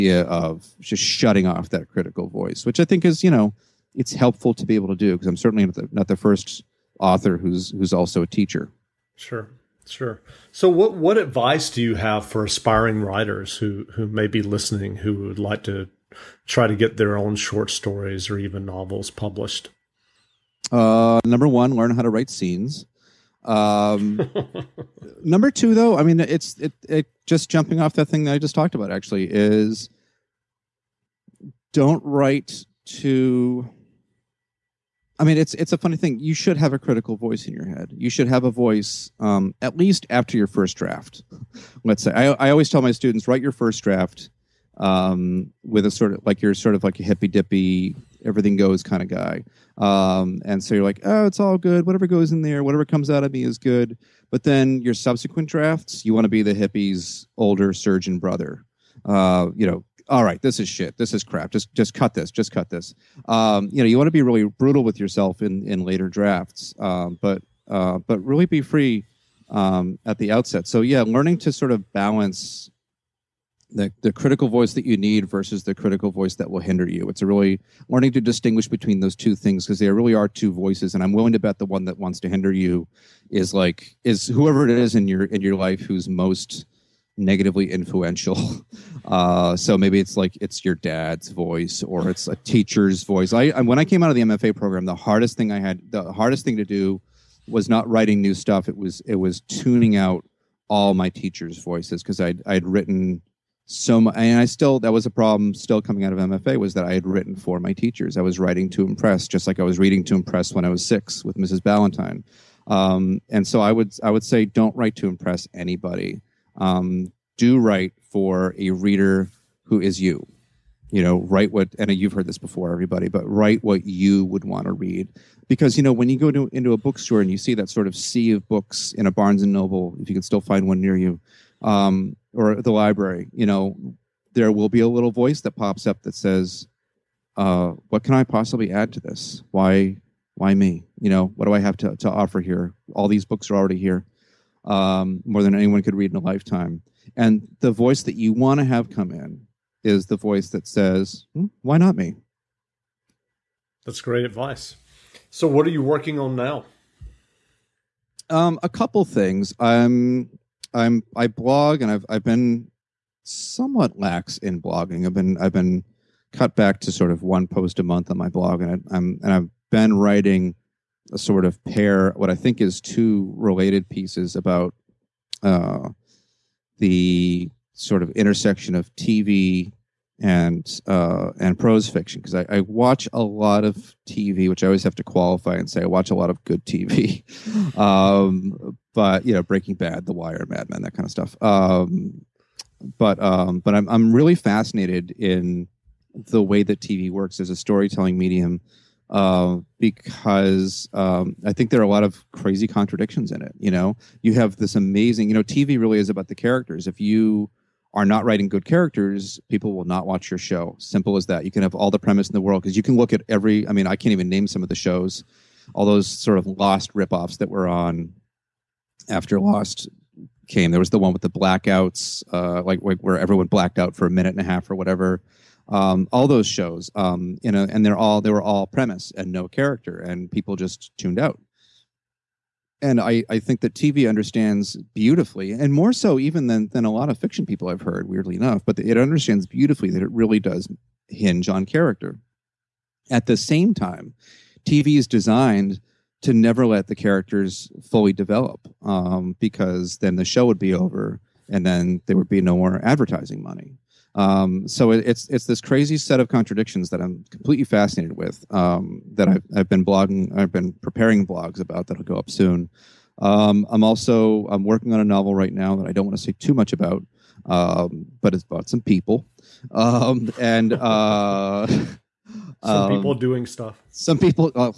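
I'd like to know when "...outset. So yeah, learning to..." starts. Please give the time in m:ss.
1:10.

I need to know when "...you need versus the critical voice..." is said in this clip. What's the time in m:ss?
1:14.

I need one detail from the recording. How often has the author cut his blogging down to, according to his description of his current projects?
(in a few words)
one post a month.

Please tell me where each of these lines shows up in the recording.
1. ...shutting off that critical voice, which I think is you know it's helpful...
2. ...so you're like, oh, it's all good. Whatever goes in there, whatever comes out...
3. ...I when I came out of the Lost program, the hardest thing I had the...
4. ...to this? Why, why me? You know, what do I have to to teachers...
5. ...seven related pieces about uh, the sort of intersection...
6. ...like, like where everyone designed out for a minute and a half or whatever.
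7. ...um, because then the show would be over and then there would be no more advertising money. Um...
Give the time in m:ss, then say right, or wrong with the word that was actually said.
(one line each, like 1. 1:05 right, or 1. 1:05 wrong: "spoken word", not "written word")
1. 0:01 right
2. 0:50 right
3. 1:33 wrong: "MFA", not "Lost"
4. 2:18 wrong: "offer", not "teachers"
5. 2:52 wrong: "two", not "seven"
6. 3:42 wrong: "blacked", not "designed"
7. 4:08 right.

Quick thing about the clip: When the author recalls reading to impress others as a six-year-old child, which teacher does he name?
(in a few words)
Mrs. Ballantyne.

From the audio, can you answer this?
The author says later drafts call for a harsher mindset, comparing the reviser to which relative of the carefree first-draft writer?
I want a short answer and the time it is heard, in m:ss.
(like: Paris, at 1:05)
older surgeon brother, at 0:57.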